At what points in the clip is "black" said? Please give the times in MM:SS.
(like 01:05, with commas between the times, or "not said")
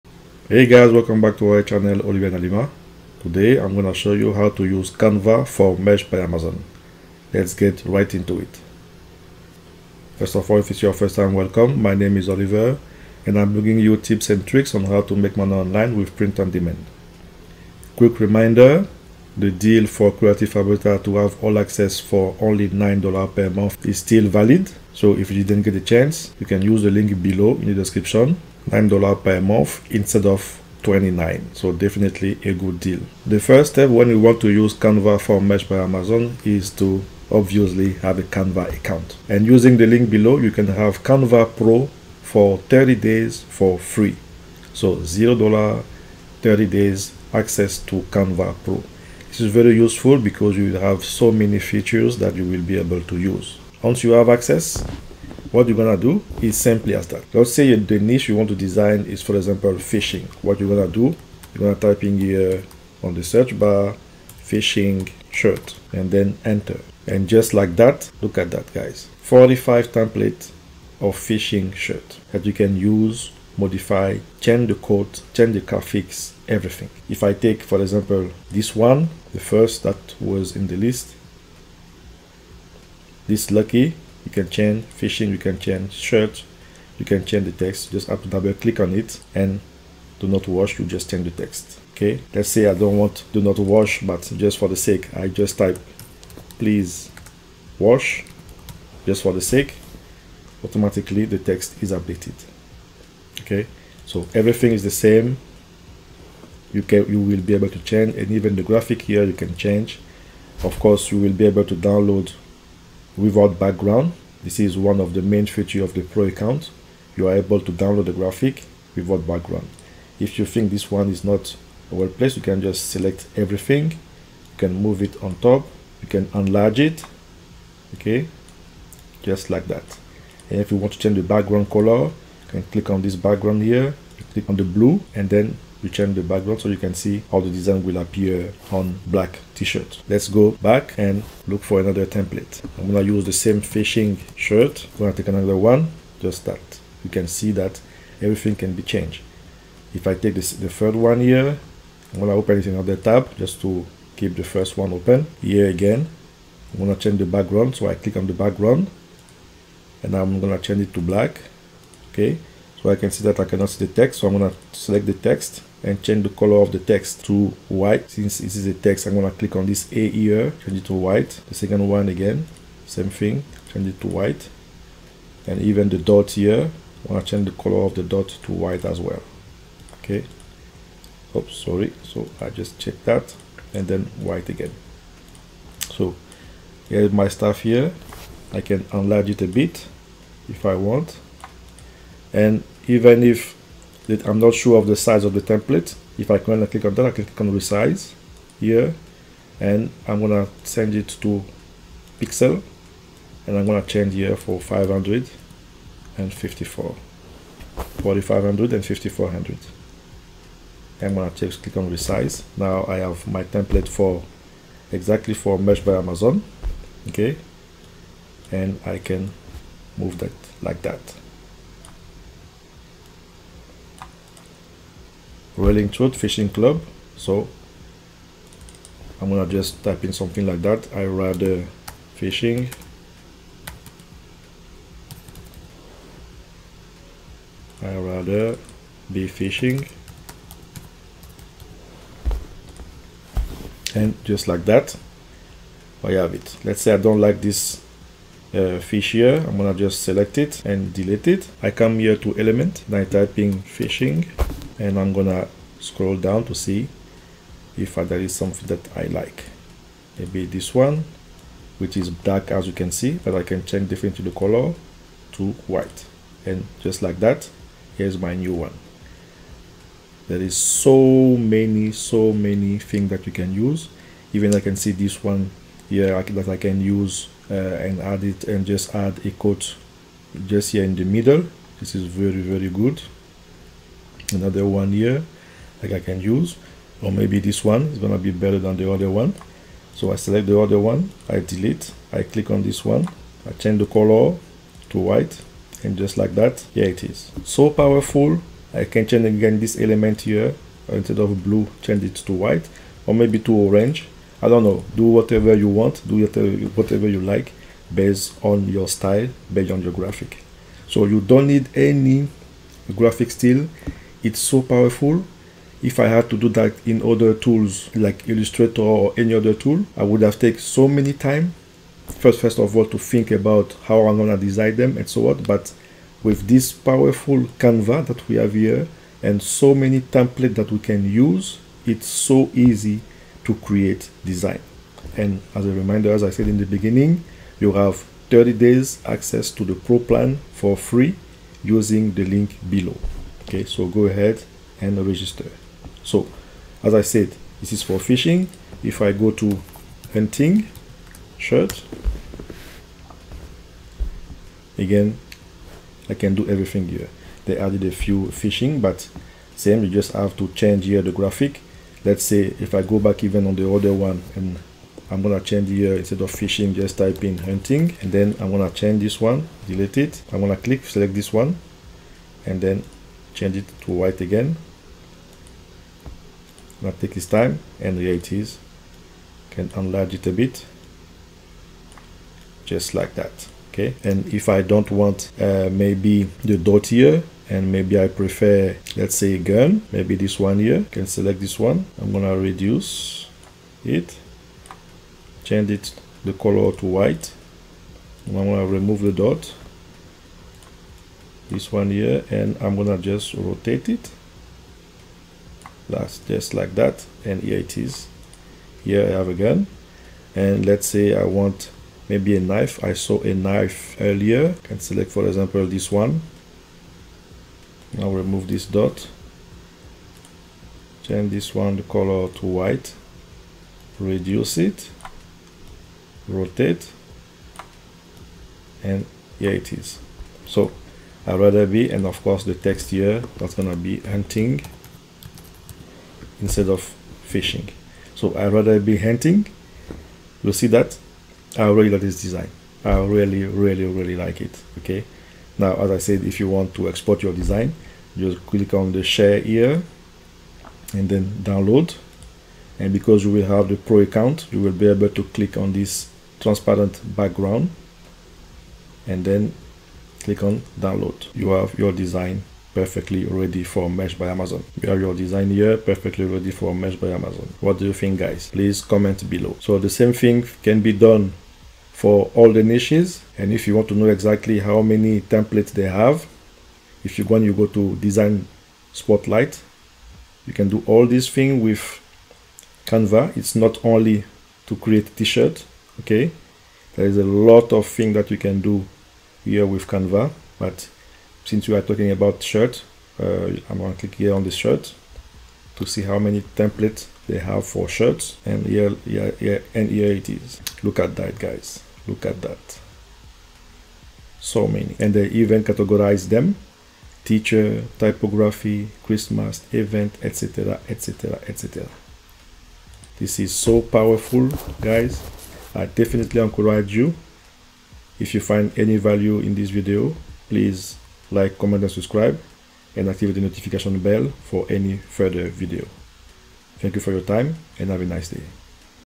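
02:19, 02:41, 04:22.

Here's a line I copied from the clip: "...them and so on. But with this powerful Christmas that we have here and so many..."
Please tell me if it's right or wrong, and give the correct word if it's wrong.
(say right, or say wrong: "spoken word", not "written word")
wrong: "Canva", not "Christmas".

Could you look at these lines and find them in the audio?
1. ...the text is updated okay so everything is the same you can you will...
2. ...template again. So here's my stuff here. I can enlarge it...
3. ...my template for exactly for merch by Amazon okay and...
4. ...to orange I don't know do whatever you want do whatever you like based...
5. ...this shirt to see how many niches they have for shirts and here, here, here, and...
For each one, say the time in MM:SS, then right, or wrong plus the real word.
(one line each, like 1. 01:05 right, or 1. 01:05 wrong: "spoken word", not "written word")
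1. 01:41 right
2. 03:04 wrong: "white", not "template"
3. 03:33 right
4. 05:03 right
5. 08:14 wrong: "templates", not "niches".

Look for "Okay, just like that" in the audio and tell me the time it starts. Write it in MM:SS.
02:07.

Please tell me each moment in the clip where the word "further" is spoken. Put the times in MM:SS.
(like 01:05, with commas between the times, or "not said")
08:44.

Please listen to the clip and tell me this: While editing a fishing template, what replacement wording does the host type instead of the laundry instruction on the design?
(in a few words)
please wash.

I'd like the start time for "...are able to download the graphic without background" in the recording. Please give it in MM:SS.
01:57.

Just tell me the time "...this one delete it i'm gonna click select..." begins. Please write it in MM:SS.
06:09.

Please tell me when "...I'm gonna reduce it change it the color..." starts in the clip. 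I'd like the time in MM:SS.
06:32.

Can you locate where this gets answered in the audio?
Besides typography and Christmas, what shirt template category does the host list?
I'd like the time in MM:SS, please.
08:27.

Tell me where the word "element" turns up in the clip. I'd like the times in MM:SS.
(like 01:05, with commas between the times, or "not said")
04:12, 04:59.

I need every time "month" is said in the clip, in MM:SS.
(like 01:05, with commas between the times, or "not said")
00:23, 00:29.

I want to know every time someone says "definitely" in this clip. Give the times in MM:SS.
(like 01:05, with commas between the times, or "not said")
00:31, 08:35.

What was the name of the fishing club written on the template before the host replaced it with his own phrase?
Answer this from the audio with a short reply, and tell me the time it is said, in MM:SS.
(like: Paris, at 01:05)
Rolling Trout Fishing Club, at 03:45.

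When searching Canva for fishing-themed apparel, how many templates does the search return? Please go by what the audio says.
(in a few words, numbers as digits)
45.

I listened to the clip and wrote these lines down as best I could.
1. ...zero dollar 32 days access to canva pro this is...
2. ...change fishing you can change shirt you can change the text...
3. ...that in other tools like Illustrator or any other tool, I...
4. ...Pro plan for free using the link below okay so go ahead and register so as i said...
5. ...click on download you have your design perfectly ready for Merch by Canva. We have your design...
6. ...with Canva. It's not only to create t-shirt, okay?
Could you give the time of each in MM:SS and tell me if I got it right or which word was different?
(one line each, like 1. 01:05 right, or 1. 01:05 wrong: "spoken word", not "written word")
1. 00:45 wrong: "30", not "32"
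2. 01:24 right
3. 05:16 right
4. 05:39 right
5. 07:40 wrong: "Amazon", not "Canva"
6. 08:01 right.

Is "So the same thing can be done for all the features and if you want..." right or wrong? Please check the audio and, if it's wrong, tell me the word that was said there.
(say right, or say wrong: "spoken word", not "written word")
wrong: "niches", not "features".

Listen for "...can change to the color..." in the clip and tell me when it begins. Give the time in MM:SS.
04:23.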